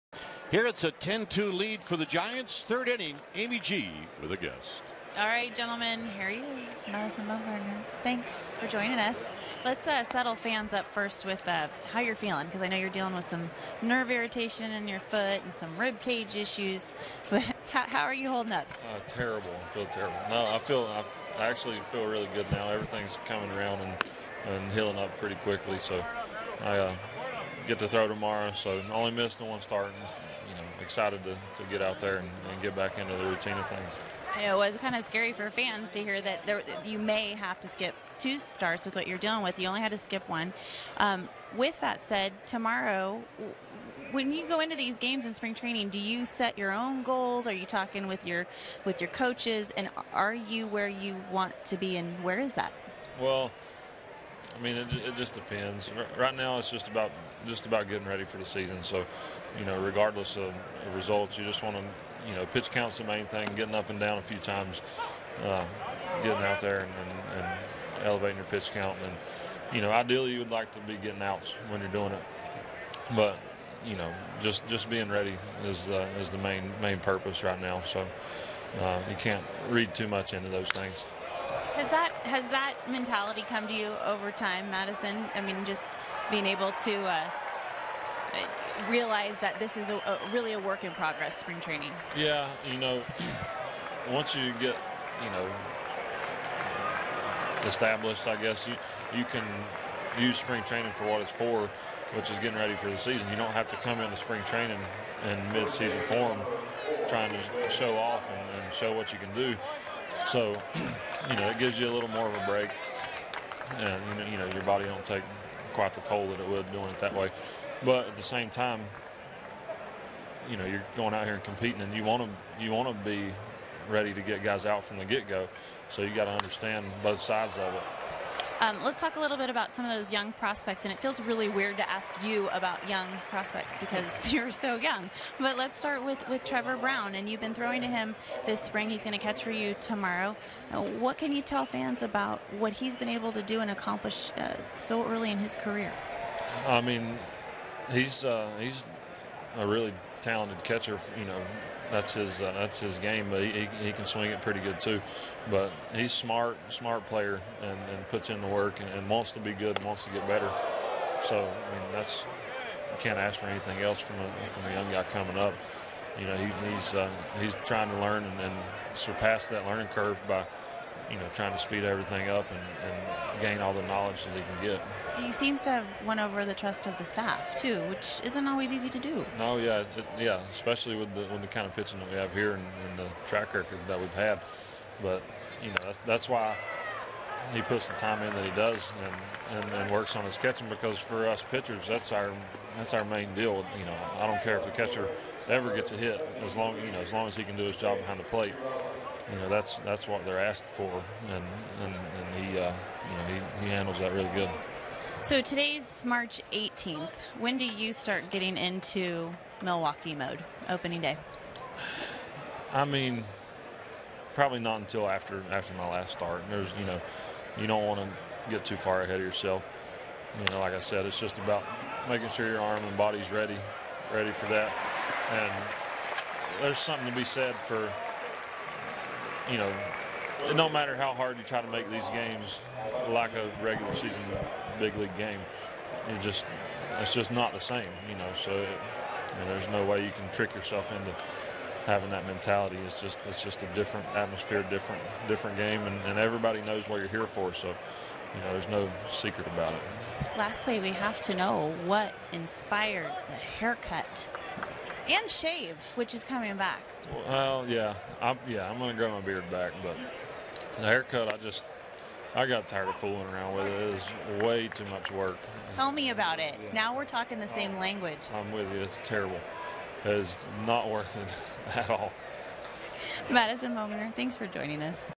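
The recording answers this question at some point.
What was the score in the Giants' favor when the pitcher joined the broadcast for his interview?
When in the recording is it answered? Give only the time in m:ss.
0:00.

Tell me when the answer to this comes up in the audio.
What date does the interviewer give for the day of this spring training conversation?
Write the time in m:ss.
3:26.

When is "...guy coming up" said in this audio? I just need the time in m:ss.
2:44.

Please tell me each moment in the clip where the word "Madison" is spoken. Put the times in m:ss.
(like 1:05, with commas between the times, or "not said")
0:06, 1:24, 4:33.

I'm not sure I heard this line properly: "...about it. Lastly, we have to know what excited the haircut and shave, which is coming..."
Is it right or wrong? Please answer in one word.
wrong.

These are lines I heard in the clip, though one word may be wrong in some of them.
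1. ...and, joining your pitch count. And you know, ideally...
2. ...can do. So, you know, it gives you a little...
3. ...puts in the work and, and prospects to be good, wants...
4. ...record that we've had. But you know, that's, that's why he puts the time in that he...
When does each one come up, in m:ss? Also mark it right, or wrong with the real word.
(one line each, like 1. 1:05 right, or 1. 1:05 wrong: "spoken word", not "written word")
1. 1:07 wrong: "elevating", not "joining"
2. 1:49 right
3. 2:38 wrong: "wants", not "prospects"
4. 3:03 right.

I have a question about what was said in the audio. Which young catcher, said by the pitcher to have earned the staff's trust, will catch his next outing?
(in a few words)
Trevor Brown.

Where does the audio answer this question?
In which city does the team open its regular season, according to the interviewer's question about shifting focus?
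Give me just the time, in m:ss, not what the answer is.
3:29.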